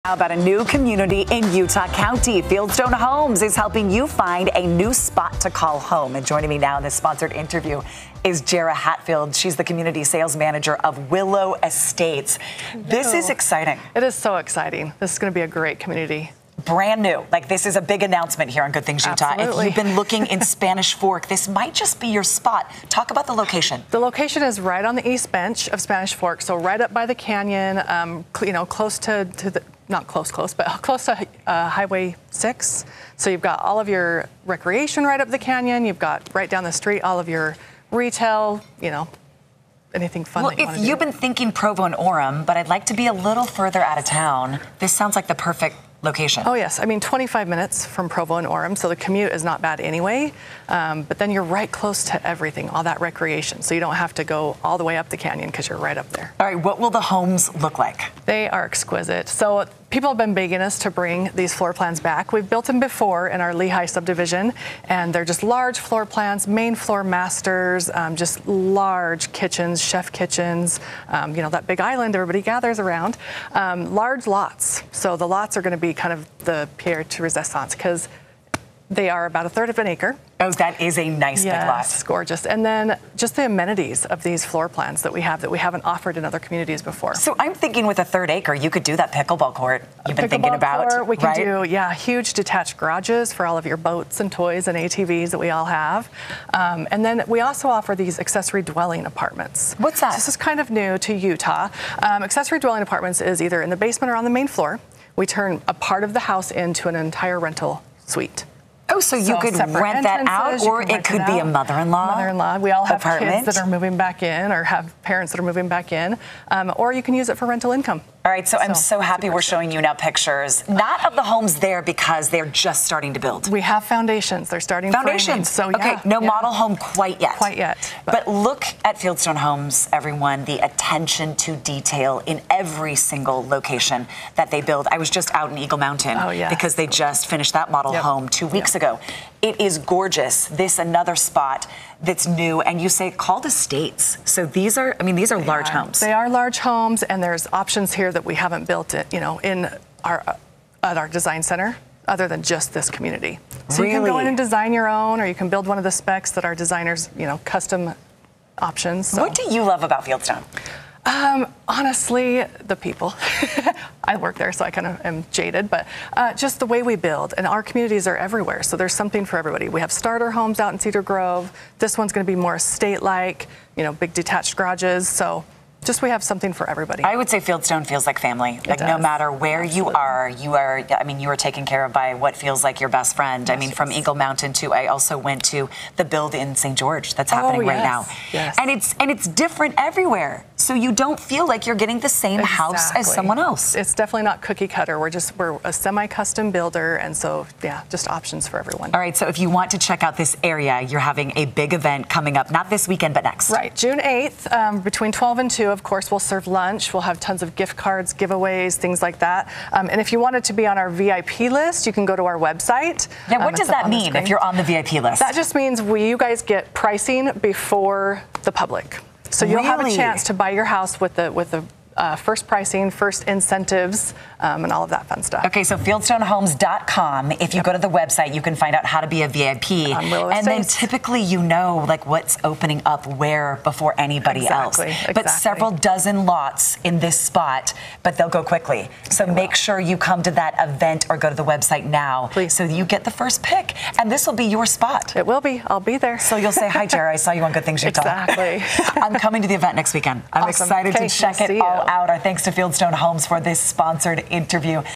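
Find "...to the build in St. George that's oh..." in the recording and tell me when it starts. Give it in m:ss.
3:05.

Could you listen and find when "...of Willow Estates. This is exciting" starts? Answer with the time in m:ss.
0:10.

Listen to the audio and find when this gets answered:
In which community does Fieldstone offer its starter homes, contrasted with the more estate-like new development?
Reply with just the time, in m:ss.
2:50.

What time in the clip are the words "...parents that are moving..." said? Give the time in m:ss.
1:55.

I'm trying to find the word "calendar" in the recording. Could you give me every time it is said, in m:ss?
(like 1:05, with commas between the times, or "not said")
not said.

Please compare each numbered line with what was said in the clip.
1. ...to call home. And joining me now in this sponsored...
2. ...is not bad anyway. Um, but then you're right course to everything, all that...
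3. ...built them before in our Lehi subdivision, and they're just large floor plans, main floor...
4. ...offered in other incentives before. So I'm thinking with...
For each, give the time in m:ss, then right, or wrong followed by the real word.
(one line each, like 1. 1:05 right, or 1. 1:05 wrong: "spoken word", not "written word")
1. 0:05 right
2. 0:49 wrong: "close", not "course"
3. 1:02 right
4. 1:25 wrong: "communities", not "incentives".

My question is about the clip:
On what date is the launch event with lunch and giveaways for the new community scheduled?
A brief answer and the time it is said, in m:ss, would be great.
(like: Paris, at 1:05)
June 8th, at 3:23.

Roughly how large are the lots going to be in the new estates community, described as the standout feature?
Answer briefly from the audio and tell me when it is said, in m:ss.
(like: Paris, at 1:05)
a third of an acre, at 1:19.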